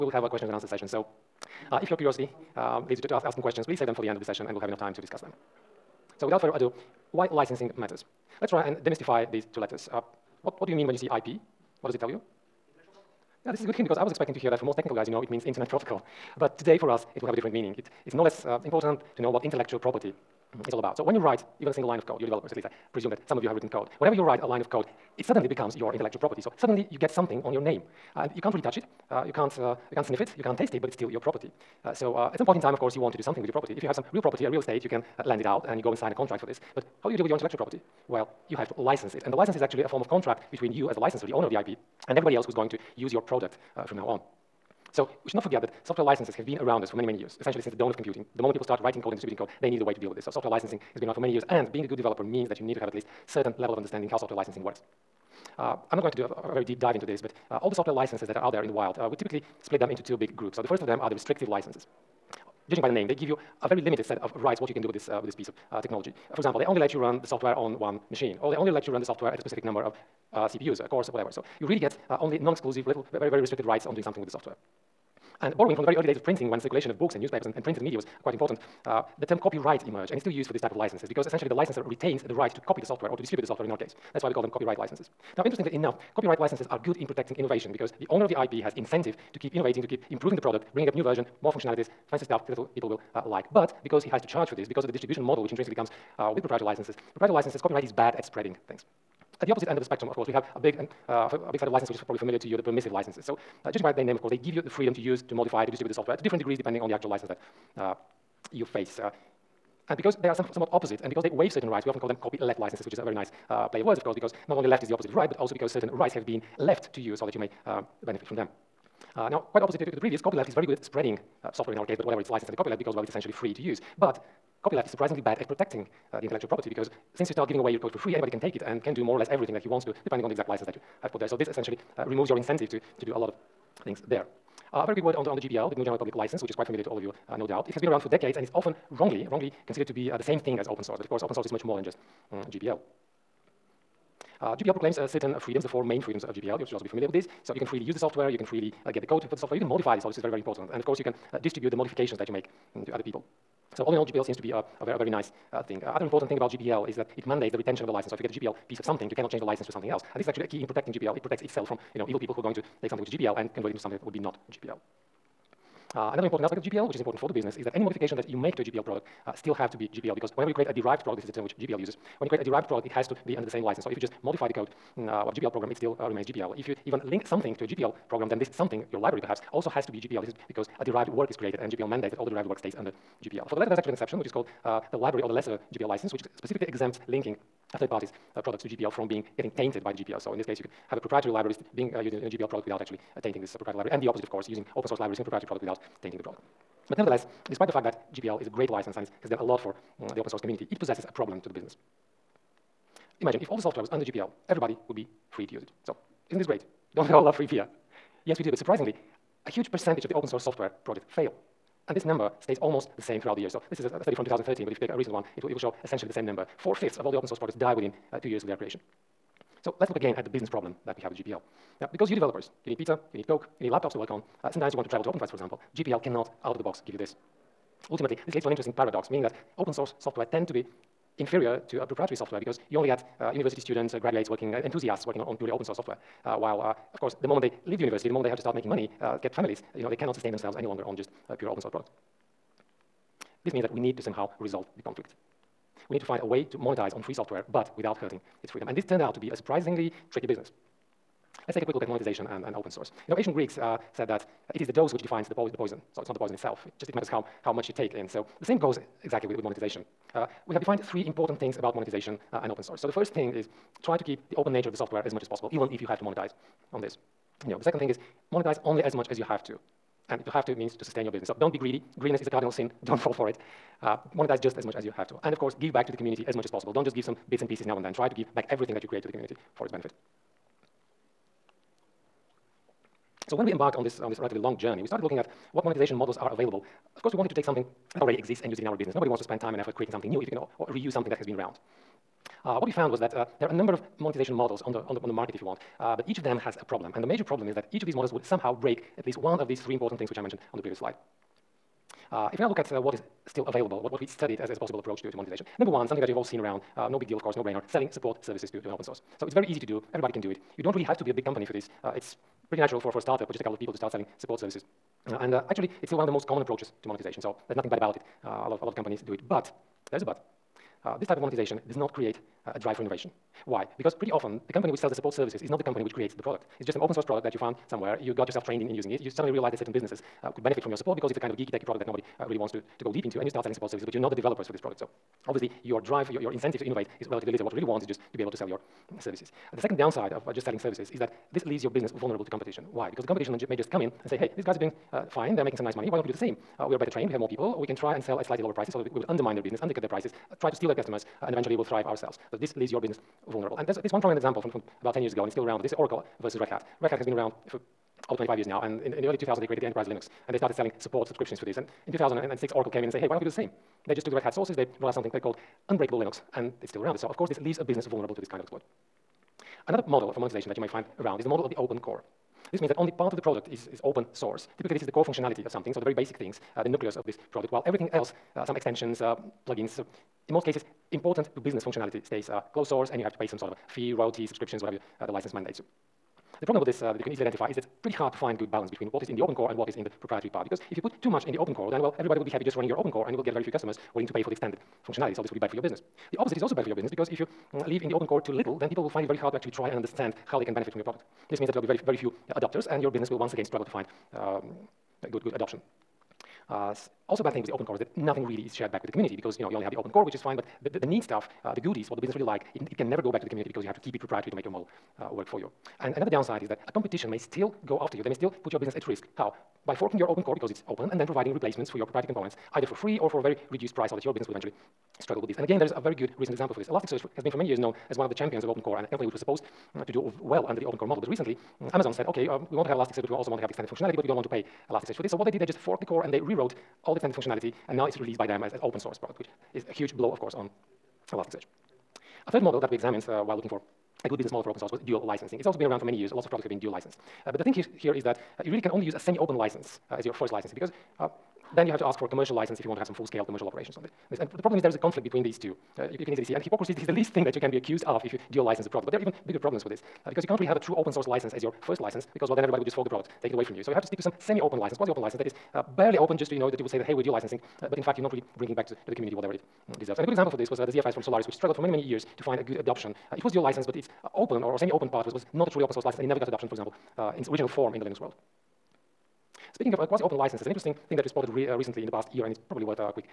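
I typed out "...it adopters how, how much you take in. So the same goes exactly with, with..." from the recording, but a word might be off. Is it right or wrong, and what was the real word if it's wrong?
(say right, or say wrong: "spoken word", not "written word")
wrong: "matters", not "adopters".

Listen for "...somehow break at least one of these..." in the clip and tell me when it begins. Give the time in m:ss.
4:58.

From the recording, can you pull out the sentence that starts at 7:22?
A third model that we examined uh, while looking for a good business model for open source was dual licensing.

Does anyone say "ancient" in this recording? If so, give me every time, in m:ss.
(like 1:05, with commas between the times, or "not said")
4:13.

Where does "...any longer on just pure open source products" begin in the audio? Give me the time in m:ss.
4:00.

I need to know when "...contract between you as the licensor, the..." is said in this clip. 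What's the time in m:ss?
0:40.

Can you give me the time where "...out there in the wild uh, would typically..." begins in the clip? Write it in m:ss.
0:58.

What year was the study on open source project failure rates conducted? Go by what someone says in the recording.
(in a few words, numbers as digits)
2013.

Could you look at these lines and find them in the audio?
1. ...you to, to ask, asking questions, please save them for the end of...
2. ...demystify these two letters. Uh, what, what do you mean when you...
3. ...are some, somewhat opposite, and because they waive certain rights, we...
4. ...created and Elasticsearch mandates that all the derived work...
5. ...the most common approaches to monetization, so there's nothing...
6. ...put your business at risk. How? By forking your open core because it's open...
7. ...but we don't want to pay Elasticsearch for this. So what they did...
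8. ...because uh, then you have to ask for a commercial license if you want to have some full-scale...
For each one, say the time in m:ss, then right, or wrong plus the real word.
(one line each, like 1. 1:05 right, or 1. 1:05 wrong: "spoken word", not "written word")
1. 0:02 right
2. 0:08 right
3. 1:50 right
4. 3:01 wrong: "GPL", not "Elasticsearch"
5. 5:16 right
6. 6:58 right
7. 7:13 right
8. 7:30 right.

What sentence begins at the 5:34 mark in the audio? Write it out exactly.
So obviously your drive, your, your incentive to innovate is relatively little.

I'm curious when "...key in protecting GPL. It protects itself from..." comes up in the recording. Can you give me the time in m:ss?
2:40.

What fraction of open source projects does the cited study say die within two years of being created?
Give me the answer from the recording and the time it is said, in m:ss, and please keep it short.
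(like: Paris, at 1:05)
Four-fifths, at 3:36.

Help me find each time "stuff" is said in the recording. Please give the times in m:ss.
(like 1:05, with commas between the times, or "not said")
1:32, 6:51.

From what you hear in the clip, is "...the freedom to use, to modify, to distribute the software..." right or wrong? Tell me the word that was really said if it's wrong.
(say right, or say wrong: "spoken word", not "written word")
right.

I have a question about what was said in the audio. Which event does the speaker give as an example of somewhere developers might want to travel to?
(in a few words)
OpenFest.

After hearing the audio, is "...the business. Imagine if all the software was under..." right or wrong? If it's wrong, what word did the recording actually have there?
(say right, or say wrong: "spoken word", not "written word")
right.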